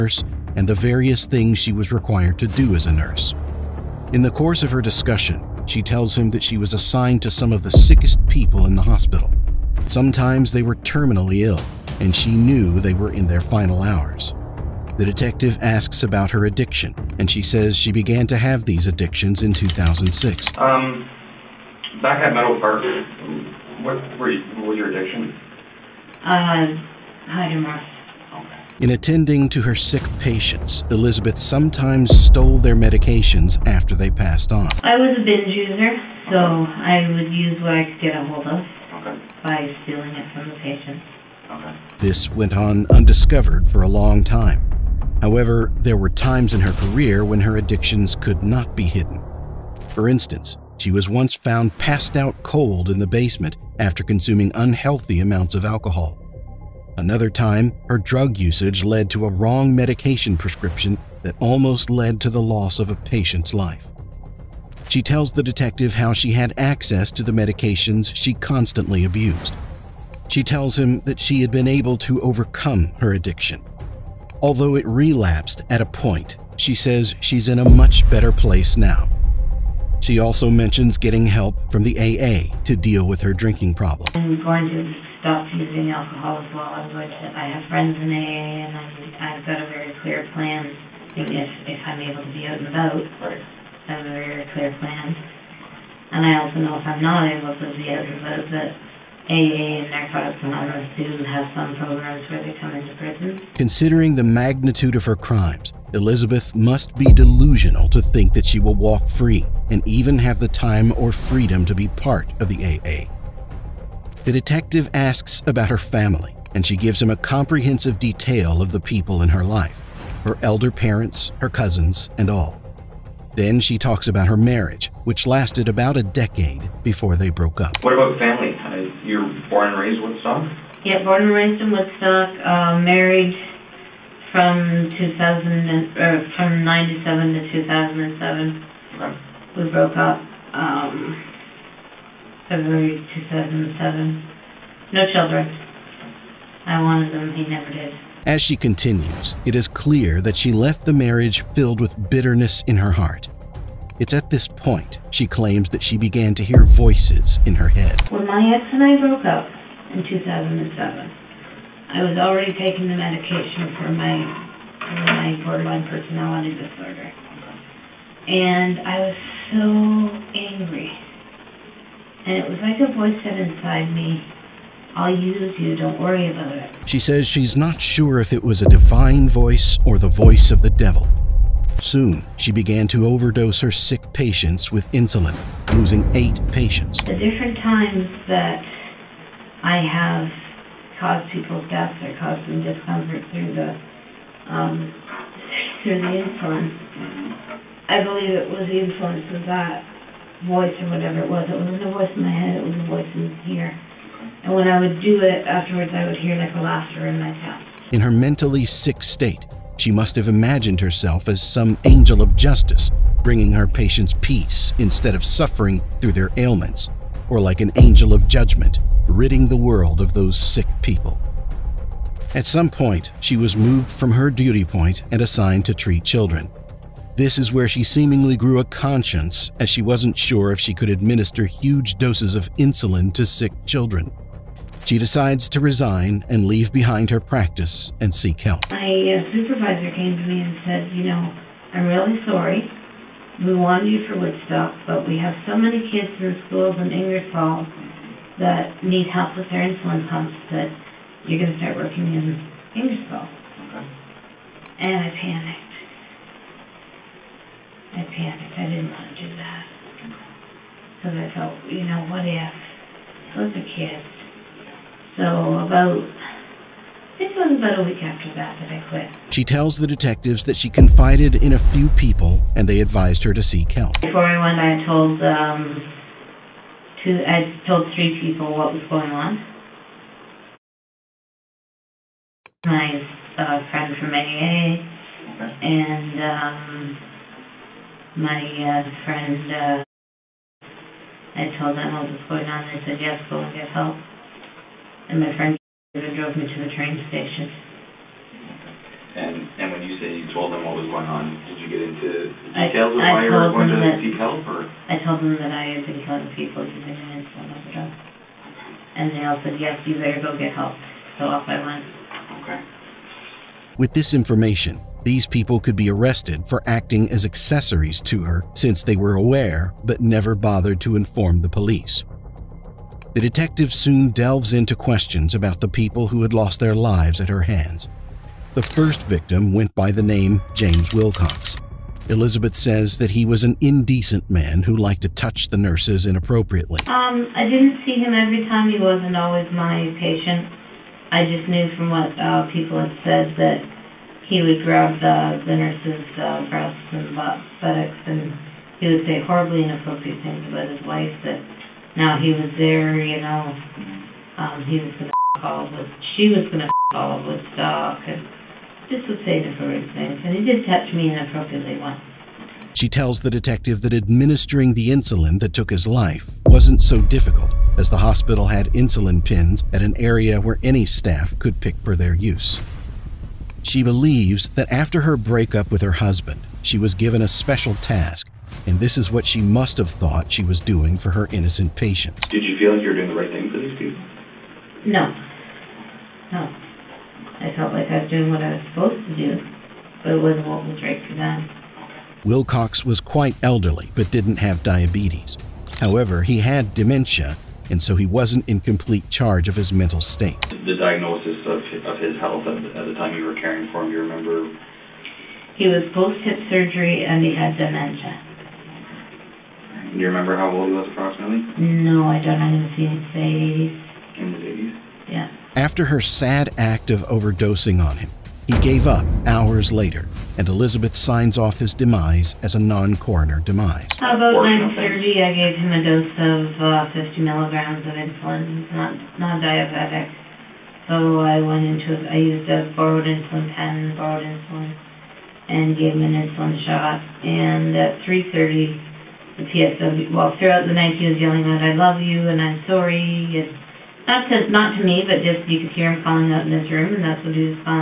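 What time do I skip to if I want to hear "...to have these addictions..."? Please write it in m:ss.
0:18.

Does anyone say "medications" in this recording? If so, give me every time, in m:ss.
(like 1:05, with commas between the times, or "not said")
0:32, 0:59, 1:07, 2:42.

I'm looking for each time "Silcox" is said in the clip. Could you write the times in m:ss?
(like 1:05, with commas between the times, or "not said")
5:30, 6:32.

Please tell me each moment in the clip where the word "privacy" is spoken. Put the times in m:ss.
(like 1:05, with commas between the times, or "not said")
not said.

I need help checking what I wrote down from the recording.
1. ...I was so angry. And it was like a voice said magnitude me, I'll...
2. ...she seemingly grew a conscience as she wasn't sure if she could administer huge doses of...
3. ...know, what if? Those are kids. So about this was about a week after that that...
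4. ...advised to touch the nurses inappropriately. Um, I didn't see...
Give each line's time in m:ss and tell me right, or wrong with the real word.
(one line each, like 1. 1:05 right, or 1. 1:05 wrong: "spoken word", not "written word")
1. 2:48 wrong: "inside", not "magnitude"
2. 3:47 right
3. 4:21 right
4. 5:34 wrong: "liked", not "advised".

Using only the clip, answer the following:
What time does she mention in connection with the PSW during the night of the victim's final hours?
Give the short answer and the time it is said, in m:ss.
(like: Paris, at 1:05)
3:30, at 7:18.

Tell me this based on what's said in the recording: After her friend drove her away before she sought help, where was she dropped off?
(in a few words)
train station.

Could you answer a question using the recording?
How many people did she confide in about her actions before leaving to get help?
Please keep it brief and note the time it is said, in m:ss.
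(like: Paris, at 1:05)
3, at 4:37.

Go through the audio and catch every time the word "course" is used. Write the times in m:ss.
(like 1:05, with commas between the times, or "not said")
0:04.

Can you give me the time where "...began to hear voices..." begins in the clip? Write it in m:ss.
2:35.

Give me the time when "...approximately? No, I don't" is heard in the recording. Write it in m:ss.
6:50.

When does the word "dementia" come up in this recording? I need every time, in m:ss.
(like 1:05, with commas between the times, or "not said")
6:36, 6:47.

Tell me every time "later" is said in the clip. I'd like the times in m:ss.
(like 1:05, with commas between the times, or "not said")
6:59.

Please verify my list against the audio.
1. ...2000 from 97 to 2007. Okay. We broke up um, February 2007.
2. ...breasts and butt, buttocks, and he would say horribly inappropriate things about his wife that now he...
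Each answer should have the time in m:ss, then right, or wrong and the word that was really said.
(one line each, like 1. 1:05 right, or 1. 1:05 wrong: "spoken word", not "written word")
1. 2:14 right
2. 5:46 right.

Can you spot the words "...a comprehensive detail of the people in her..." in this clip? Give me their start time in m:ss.
1:57.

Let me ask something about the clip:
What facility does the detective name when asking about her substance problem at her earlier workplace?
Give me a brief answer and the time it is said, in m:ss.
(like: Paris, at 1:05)
Meadow Park, at 0:22.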